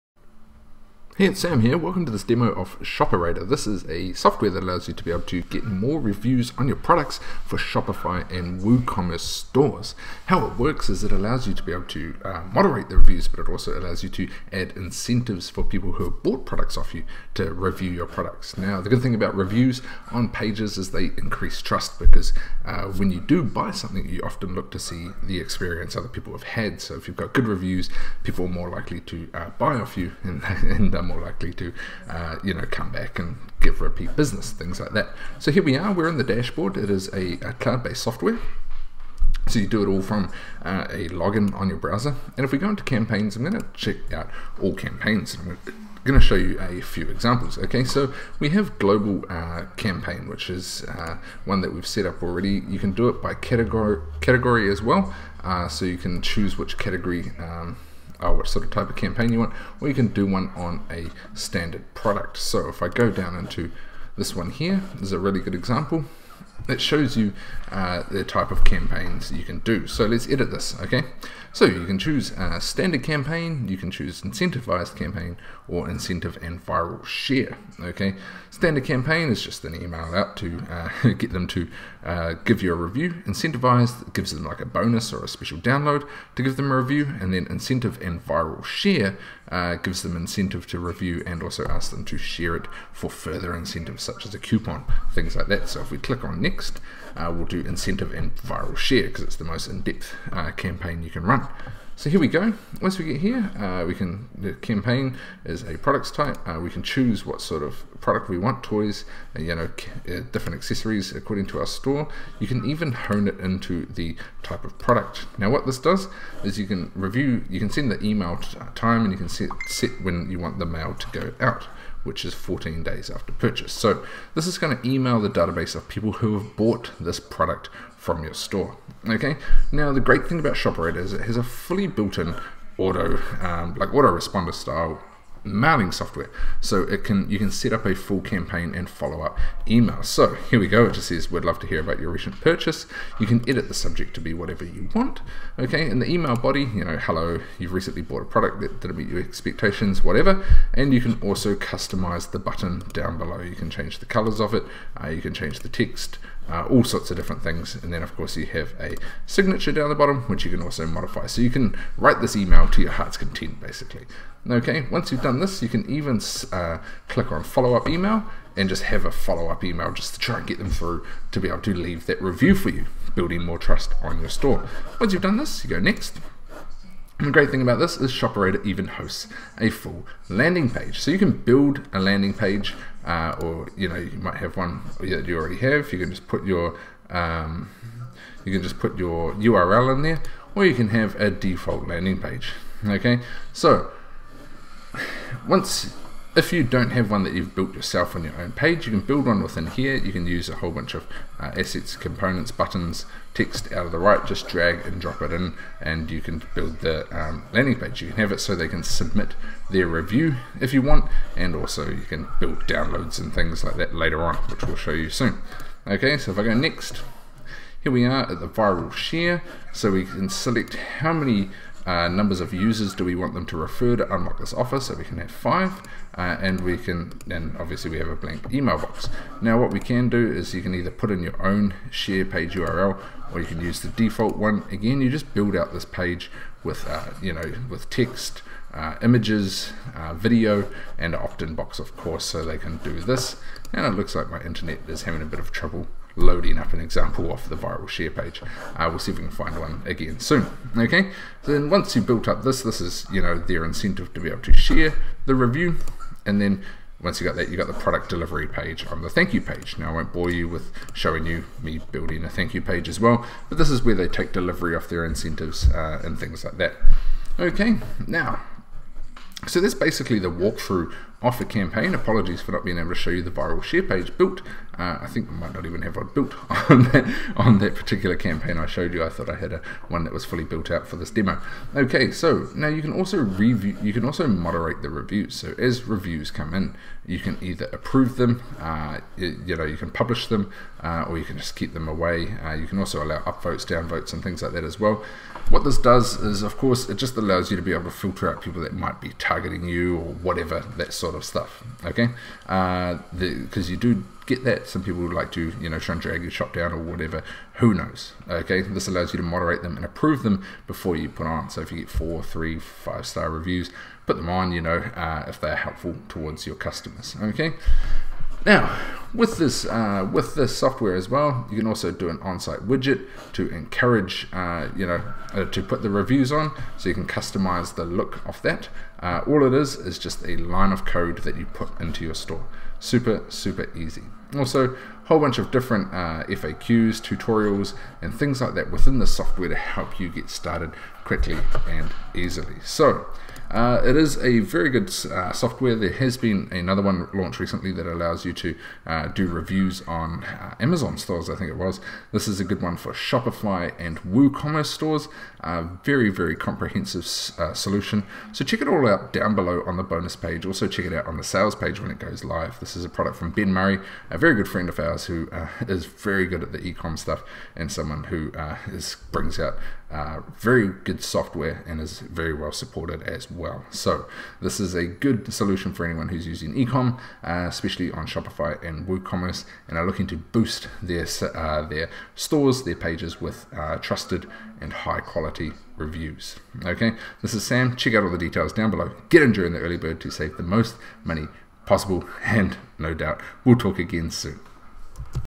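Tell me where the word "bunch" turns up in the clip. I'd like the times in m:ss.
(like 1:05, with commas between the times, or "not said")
3:20, 5:35.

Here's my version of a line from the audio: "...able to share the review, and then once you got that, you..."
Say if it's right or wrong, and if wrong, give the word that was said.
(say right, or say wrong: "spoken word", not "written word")
right.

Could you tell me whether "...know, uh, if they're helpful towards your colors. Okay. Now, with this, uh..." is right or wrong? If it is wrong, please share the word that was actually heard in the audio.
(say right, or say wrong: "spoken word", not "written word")
wrong: "customers", not "colors".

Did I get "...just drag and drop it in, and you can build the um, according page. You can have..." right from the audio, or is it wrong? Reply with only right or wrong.
wrong.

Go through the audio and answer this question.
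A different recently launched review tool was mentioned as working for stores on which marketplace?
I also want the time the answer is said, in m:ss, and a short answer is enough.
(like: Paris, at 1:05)
Amazon, at 5:50.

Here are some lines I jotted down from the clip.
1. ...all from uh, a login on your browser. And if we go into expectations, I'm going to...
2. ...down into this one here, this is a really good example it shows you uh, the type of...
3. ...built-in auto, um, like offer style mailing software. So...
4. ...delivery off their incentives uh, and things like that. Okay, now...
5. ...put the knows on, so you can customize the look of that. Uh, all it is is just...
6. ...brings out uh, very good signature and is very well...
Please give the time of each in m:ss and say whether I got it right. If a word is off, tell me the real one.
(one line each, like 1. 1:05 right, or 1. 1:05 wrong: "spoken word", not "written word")
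1. 0:39 wrong: "campaigns", not "expectations"
2. 1:03 right
3. 2:11 wrong: "autoresponder", not "offer"
4. 4:24 right
5. 5:25 wrong: "reviews", not "knows"
6. 6:09 wrong: "software", not "signature".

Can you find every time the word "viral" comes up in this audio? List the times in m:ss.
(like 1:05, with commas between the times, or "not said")
1:16, 1:28, 1:38, 3:38, 4:07, 4:33.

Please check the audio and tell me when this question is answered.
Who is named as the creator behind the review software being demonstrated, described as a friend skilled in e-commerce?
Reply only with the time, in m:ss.
6:03.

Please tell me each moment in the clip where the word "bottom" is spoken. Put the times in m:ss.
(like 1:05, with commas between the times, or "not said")
2:39.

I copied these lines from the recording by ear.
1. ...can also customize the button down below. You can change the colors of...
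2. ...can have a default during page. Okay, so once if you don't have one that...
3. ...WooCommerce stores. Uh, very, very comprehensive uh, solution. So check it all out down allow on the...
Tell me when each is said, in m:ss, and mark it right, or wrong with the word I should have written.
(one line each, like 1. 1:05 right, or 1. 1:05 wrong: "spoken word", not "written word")
1. 2:31 right
2. 3:10 wrong: "landing", not "during"
3. 5:54 wrong: "below", not "allow".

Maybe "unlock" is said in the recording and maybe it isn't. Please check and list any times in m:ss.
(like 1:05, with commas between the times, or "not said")
3:44.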